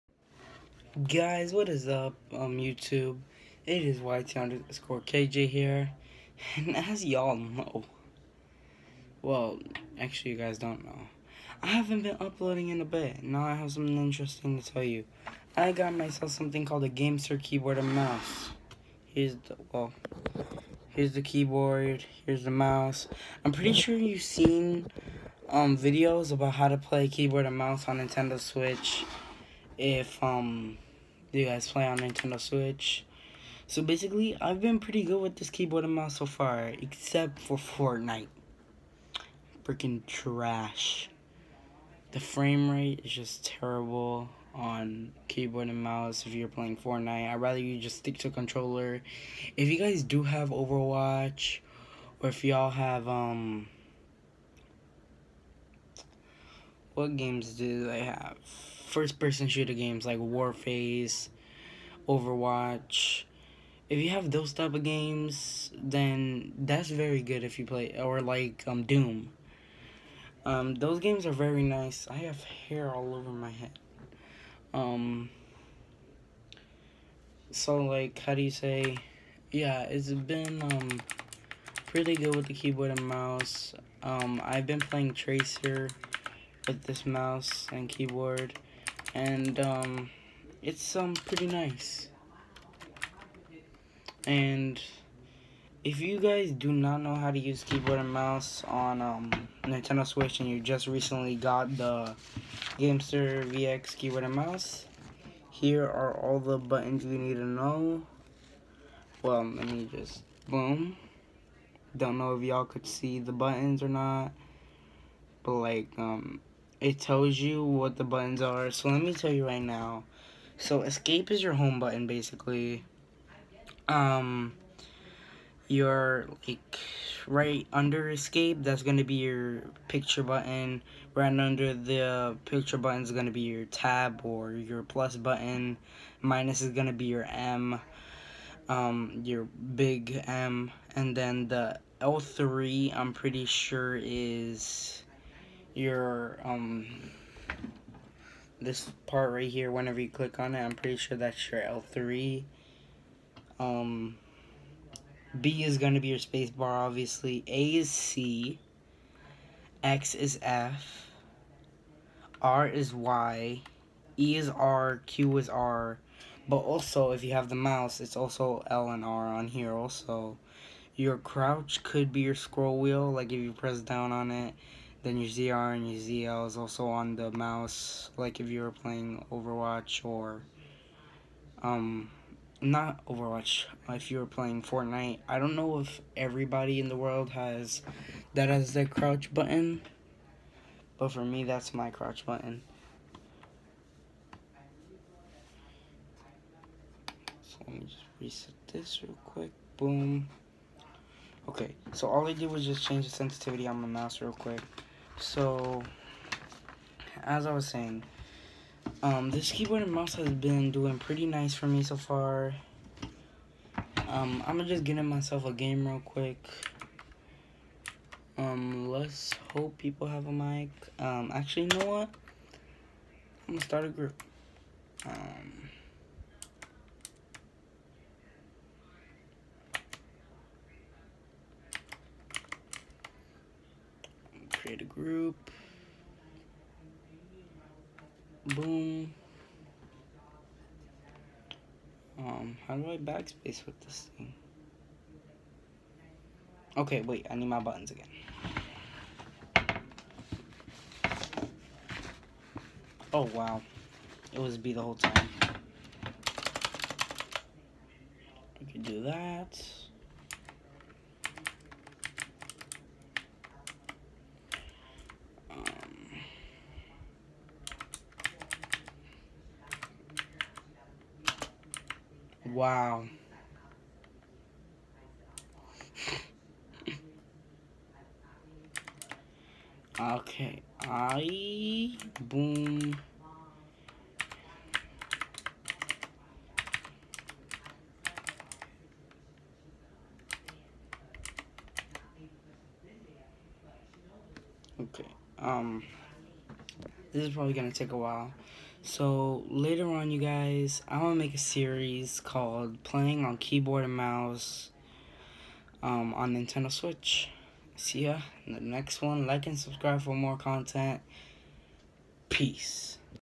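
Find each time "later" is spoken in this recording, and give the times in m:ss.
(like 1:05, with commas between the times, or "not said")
4:59.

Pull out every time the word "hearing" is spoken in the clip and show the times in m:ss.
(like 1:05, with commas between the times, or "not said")
not said.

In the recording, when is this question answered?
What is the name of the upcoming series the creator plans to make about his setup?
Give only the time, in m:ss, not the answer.
5:02.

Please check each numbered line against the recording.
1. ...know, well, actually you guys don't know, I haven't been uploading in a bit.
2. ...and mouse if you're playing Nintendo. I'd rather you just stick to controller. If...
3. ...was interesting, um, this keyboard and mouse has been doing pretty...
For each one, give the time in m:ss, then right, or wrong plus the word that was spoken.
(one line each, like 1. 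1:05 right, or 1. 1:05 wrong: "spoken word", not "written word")
1. 0:07 right
2. 0:45 wrong: "Fortnite", not "Nintendo"
3. 3:27 wrong: "saying", not "interesting".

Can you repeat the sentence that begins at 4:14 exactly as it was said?
It was B the whole time.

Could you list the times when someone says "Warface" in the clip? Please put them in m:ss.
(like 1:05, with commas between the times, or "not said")
1:00.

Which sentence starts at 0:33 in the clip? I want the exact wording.
So basically, I've been pretty good with this keyboard and mouse so far, except for Fortnite.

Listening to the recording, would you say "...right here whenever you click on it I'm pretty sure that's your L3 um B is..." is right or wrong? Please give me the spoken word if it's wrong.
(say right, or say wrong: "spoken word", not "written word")
right.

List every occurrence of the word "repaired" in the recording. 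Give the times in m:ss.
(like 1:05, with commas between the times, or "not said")
not said.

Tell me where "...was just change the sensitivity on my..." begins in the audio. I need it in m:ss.
3:22.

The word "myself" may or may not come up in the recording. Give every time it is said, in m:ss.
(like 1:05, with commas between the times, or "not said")
0:15, 3:35.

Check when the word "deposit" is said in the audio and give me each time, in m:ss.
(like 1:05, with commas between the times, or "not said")
not said.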